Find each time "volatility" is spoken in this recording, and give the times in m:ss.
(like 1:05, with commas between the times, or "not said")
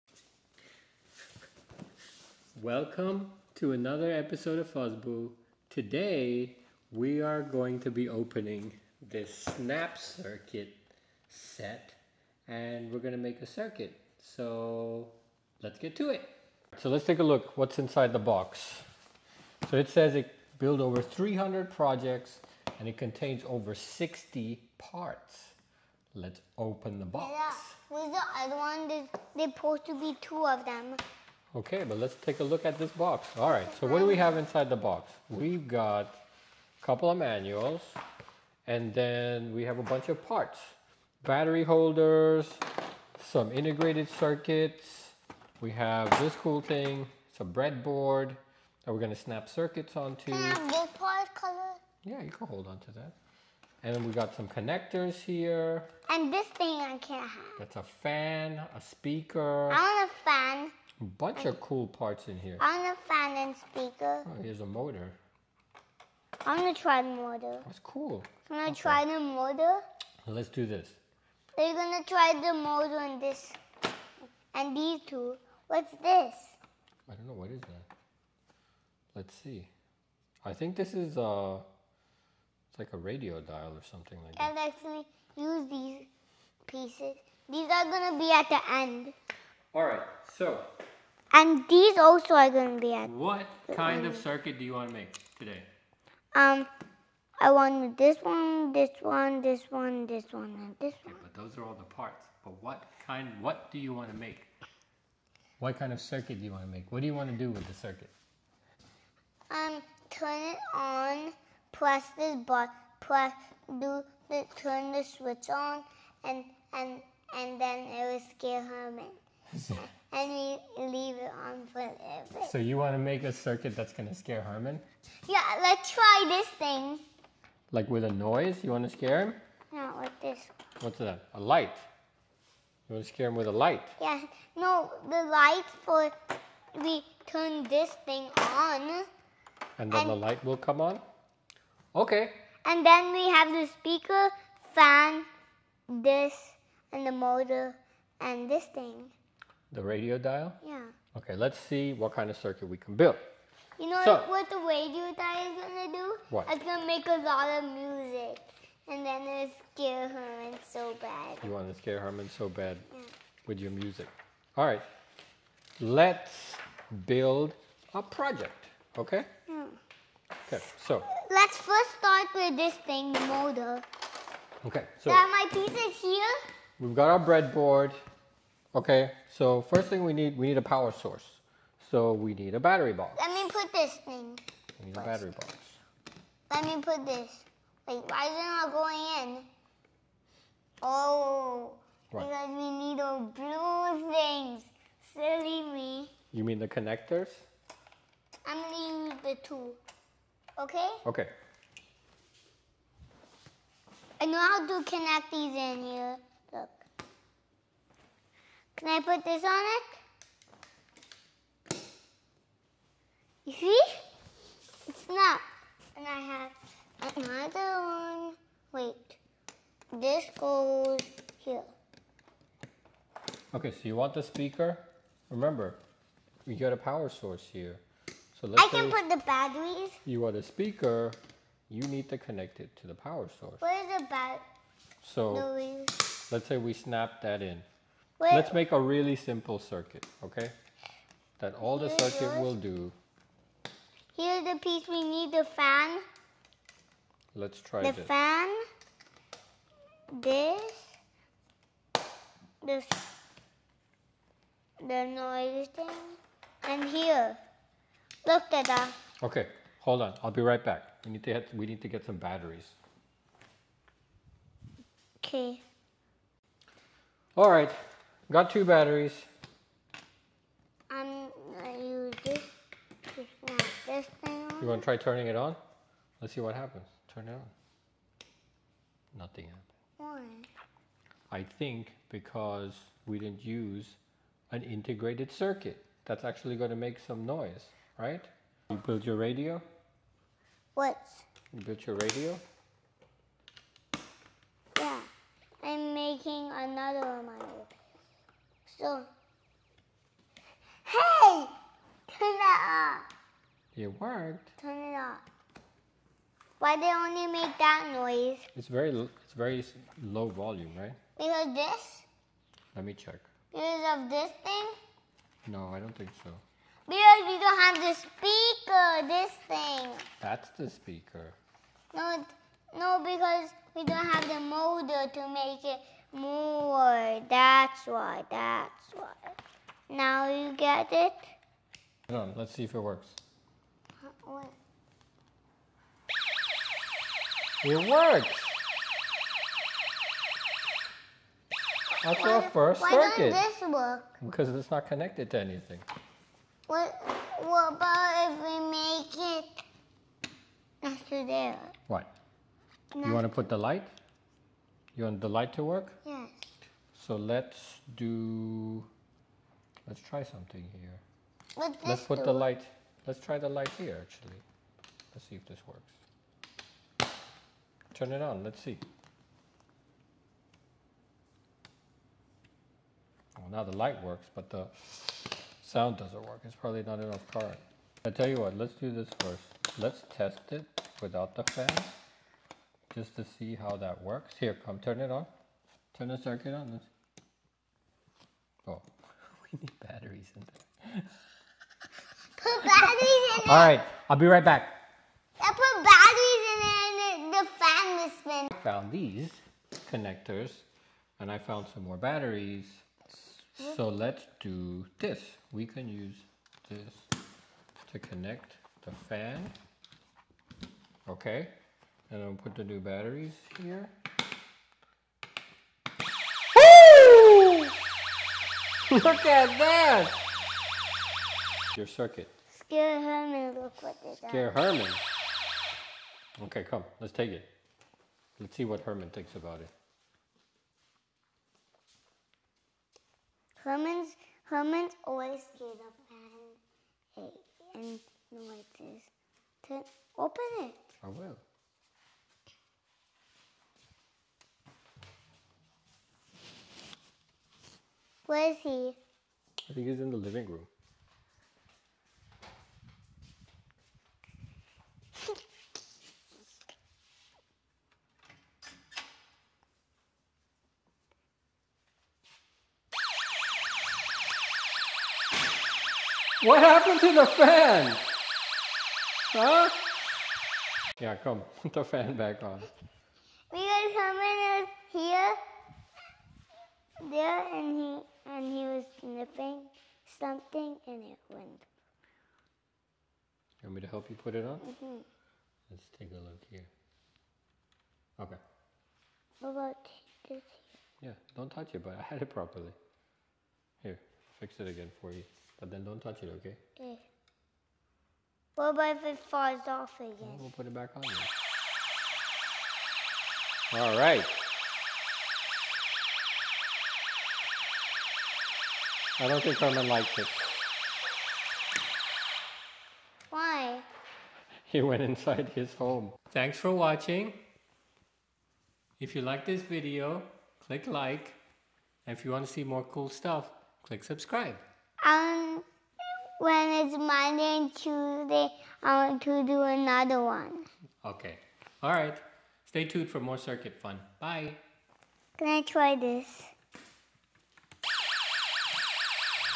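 not said.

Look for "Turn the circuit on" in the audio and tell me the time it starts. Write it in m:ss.
6:25.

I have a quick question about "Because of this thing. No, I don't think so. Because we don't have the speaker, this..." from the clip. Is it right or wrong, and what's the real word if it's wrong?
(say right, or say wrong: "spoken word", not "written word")
right.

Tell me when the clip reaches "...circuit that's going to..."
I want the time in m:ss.
2:03.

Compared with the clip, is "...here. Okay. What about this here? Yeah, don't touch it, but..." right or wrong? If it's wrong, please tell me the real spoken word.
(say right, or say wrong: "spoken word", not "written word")
right.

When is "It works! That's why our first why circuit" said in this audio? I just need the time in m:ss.
5:37.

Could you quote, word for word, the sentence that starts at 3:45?
Remember, we got a power source here.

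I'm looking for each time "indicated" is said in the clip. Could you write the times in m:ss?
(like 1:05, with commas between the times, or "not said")
not said.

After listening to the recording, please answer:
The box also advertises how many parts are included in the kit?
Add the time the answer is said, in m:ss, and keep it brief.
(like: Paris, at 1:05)
over 60, at 0:23.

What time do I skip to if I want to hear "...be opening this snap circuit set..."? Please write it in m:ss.
0:07.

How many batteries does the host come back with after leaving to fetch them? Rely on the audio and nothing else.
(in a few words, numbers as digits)
2.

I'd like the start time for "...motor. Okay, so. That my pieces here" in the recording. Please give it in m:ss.
2:53.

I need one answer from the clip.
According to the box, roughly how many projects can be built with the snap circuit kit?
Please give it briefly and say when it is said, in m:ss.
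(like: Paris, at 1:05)
over 300, at 0:20.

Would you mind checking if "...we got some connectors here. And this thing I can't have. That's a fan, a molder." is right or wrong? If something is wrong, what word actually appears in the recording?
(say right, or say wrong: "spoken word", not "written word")
wrong: "speaker", not "molder".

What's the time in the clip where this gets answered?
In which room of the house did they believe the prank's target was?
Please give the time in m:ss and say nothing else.
7:30.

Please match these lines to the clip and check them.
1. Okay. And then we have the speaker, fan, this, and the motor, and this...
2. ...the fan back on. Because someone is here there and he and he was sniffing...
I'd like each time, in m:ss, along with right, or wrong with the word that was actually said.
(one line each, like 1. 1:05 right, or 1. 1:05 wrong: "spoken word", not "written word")
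1. 2:21 right
2. 7:51 right.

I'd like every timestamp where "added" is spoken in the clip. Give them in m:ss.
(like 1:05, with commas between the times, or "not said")
1:32.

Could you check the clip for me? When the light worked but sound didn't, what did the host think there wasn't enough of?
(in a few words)
current.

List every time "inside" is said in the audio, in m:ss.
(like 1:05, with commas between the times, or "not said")
0:17, 0:34, 8:35.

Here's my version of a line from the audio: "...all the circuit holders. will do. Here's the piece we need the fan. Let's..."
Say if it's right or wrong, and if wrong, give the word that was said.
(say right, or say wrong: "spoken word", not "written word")
wrong: "yours", not "holders".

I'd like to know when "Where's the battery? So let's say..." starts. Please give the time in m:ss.
3:53.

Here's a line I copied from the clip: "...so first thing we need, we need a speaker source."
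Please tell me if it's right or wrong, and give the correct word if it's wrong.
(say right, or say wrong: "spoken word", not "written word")
wrong: "power", not "speaker".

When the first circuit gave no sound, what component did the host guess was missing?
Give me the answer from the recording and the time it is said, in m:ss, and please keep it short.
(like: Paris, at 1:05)
integrated circuit, at 4:44.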